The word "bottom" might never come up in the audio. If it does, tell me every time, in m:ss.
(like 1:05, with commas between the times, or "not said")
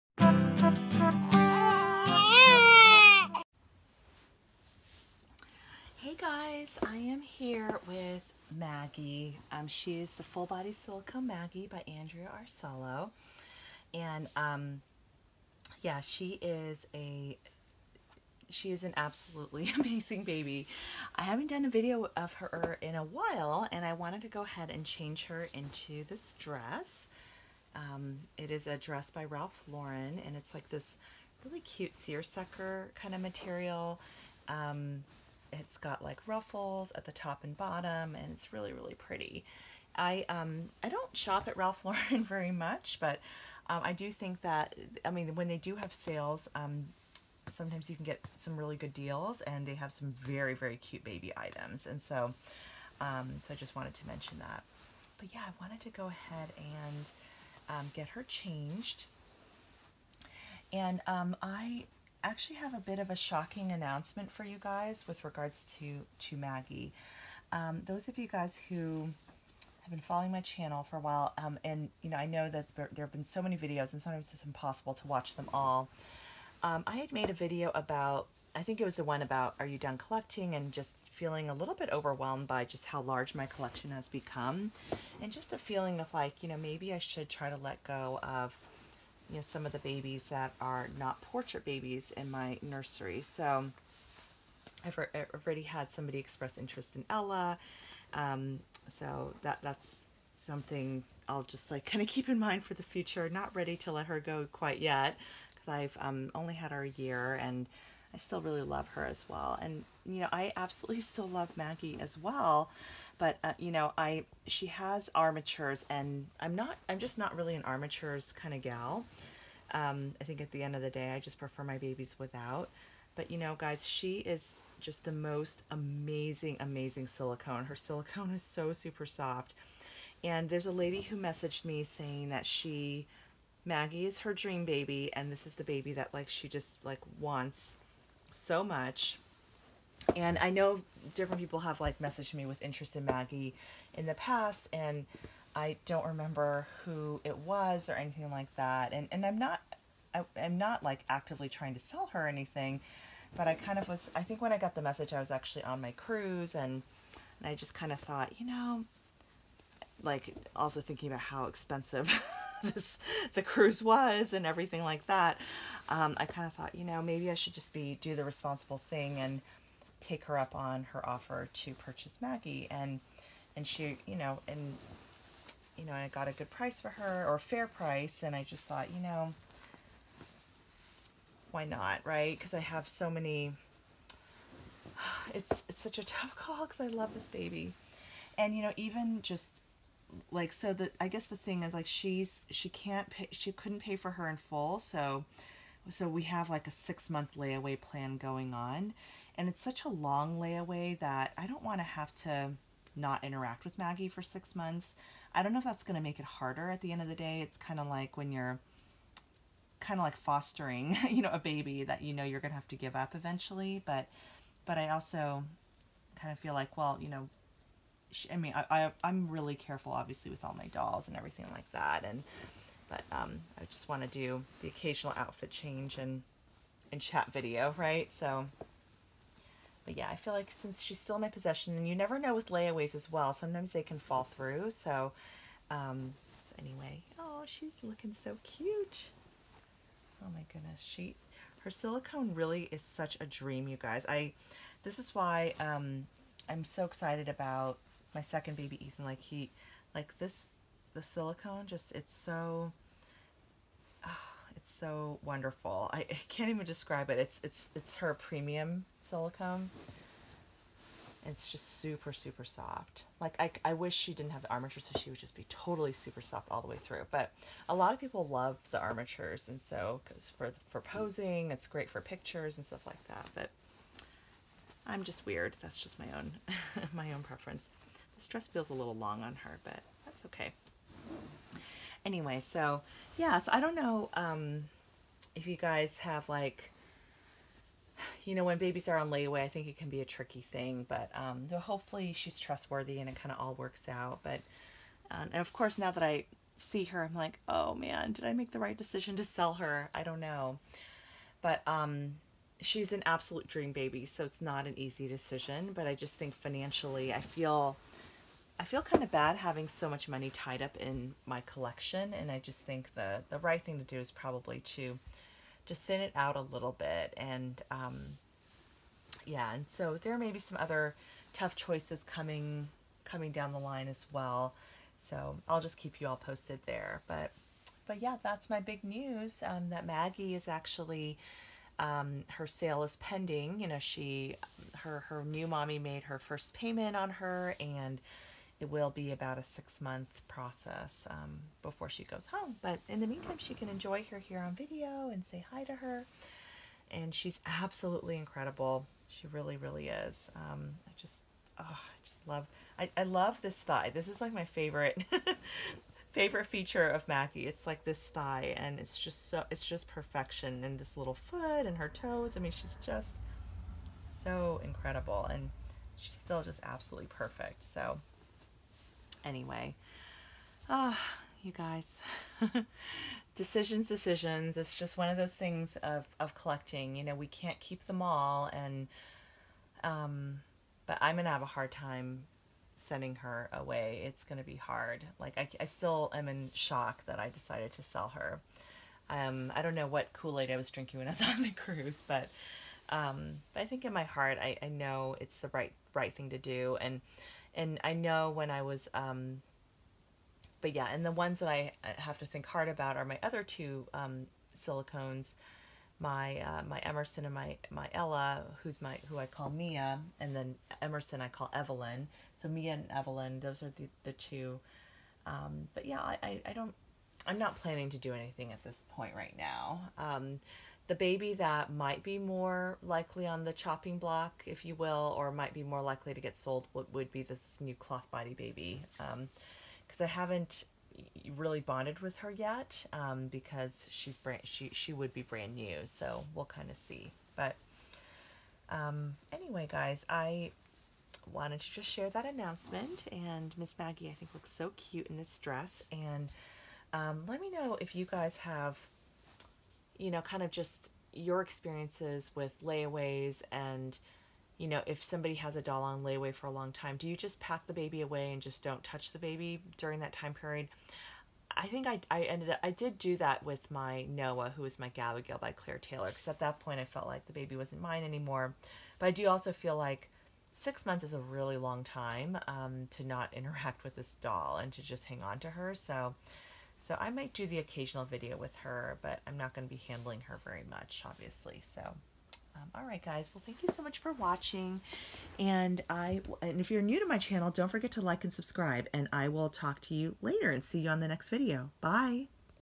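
0:37.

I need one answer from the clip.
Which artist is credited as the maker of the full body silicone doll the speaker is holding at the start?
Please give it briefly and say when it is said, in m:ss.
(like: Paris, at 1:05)
Andrea Arcello, at 0:11.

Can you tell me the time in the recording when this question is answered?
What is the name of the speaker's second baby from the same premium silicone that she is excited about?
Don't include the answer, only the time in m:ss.
4:08.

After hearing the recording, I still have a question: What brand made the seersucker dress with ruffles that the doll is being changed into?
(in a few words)
Ralph Lauren.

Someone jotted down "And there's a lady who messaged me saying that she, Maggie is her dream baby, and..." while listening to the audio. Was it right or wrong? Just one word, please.
right.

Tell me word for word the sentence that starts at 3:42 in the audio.
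And, but um, I just want to do the occasional outfit change and, and chat video, right?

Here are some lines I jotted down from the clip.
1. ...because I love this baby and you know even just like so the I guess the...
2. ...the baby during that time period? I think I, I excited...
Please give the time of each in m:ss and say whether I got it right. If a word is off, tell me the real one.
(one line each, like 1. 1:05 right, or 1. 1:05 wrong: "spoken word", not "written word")
1. 3:06 right
2. 7:39 wrong: "ended", not "excited".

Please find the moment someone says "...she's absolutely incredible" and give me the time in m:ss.
5:47.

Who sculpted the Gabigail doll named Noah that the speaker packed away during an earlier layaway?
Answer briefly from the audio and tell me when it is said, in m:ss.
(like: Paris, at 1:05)
Claire Taylor, at 7:45.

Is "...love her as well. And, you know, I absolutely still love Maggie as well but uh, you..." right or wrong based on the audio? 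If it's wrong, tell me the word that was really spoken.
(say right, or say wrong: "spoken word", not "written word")
right.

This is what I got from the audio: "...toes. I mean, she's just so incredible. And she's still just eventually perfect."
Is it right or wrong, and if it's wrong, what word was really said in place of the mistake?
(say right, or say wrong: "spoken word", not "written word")
wrong: "absolutely", not "eventually".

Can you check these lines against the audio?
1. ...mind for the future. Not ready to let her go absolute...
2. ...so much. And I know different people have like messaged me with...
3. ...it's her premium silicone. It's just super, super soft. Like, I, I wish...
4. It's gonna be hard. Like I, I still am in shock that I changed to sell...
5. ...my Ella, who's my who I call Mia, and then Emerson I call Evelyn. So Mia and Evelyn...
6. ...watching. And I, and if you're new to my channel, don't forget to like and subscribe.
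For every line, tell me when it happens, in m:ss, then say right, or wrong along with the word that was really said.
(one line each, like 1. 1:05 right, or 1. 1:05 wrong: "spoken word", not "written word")
1. 1:42 wrong: "quite", not "absolute"
2. 2:18 right
3. 4:17 right
4. 6:24 wrong: "decided", not "changed"
5. 6:47 right
6. 8:04 right.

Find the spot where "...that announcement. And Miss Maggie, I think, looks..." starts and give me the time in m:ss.
7:22.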